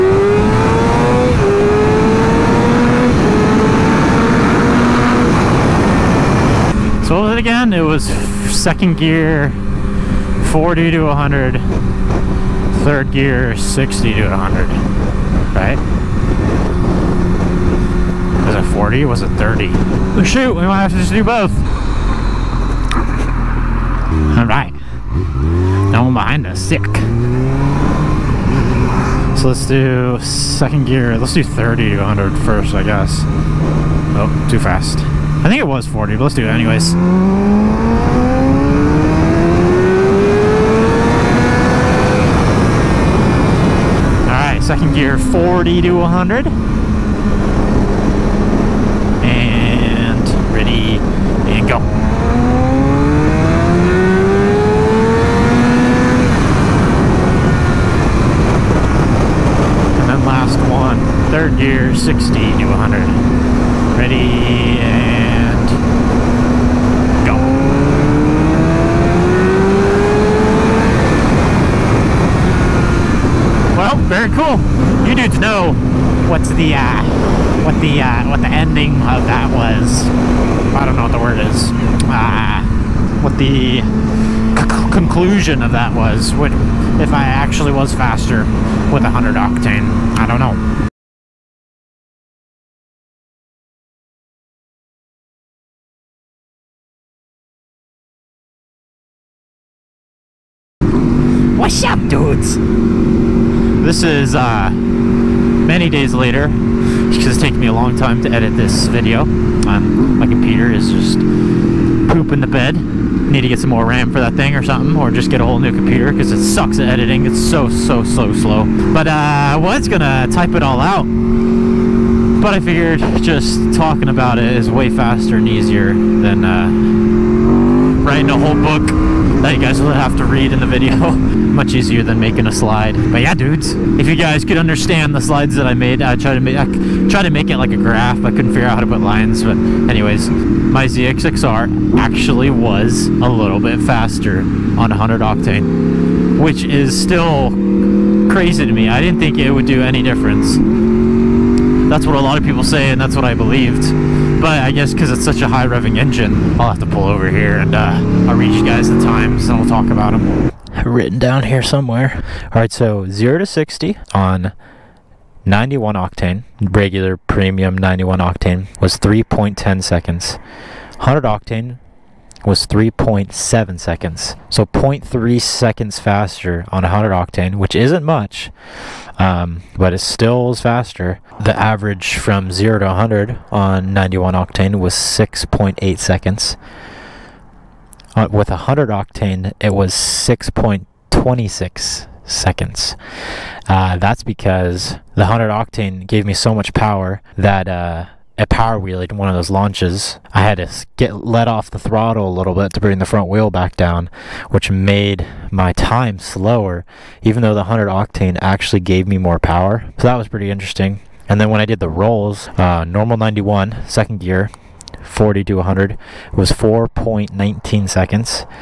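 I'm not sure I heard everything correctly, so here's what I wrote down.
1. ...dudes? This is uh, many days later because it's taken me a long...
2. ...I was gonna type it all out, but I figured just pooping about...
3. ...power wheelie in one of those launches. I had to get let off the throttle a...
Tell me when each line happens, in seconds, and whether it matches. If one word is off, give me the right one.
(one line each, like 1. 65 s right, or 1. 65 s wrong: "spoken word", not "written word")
1. 102 s right
2. 119 s wrong: "talking", not "pooping"
3. 198 s right.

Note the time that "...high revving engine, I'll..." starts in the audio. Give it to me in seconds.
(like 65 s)
155 s.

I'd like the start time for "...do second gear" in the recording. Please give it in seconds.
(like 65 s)
29 s.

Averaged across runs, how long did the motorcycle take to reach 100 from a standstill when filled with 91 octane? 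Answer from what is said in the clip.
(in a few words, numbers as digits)
6.8 seconds.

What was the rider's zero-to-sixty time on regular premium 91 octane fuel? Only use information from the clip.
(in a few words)
3.10 seconds.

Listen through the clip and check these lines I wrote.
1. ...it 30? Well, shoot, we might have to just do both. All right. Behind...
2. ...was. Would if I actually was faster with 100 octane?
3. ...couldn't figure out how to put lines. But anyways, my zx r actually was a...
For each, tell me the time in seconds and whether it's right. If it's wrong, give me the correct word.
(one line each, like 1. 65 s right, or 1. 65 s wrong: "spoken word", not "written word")
1. 19 s right
2. 85 s right
3. 138 s right.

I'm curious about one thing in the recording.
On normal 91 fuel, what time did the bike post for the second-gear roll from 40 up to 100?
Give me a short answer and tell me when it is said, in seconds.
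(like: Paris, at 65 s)
4.19 seconds, at 216 s.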